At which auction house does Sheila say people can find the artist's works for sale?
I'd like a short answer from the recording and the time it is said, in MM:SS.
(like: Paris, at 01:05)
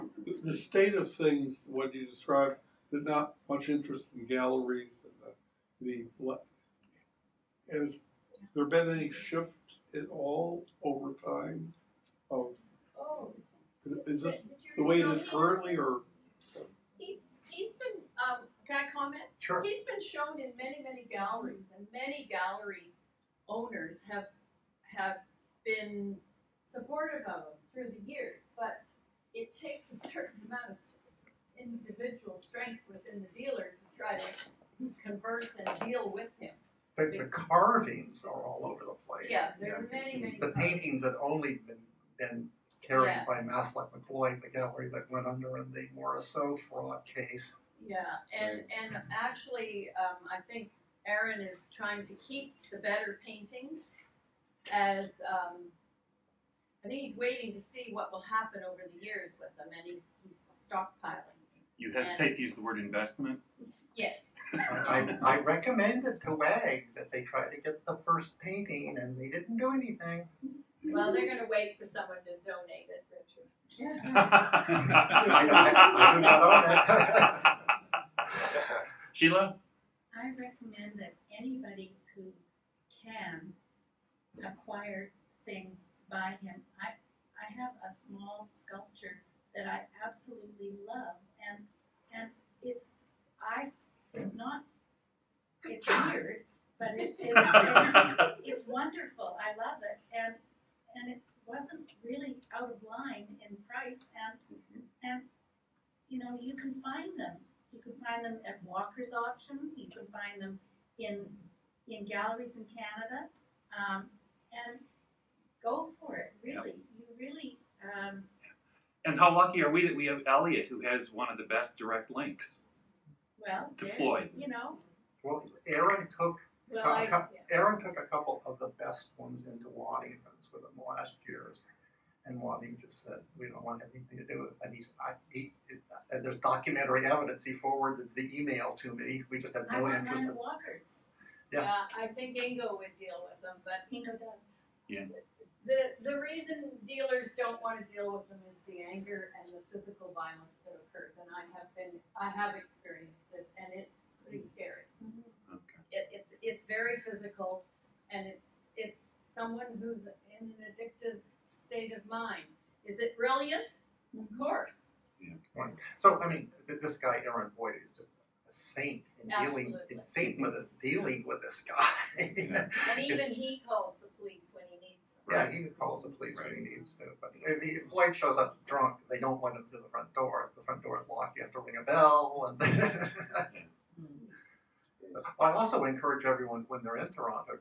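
Walker's, at 01:48.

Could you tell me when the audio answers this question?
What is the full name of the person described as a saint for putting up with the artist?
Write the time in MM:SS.
02:47.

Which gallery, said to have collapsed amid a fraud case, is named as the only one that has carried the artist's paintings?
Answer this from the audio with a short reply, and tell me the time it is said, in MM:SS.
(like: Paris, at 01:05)
Maslak McLeod, at 00:43.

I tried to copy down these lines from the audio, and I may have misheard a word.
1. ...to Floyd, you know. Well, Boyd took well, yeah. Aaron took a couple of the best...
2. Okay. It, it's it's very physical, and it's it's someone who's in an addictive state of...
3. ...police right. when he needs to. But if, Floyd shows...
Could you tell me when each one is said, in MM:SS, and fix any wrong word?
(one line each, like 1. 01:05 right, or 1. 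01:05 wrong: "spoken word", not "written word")
1. 02:03 wrong: "Aaron", not "Boyd"
2. 02:35 right
3. 02:56 right.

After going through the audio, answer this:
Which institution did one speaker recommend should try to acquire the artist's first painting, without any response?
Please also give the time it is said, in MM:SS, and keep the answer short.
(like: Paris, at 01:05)
WAG, at 01:06.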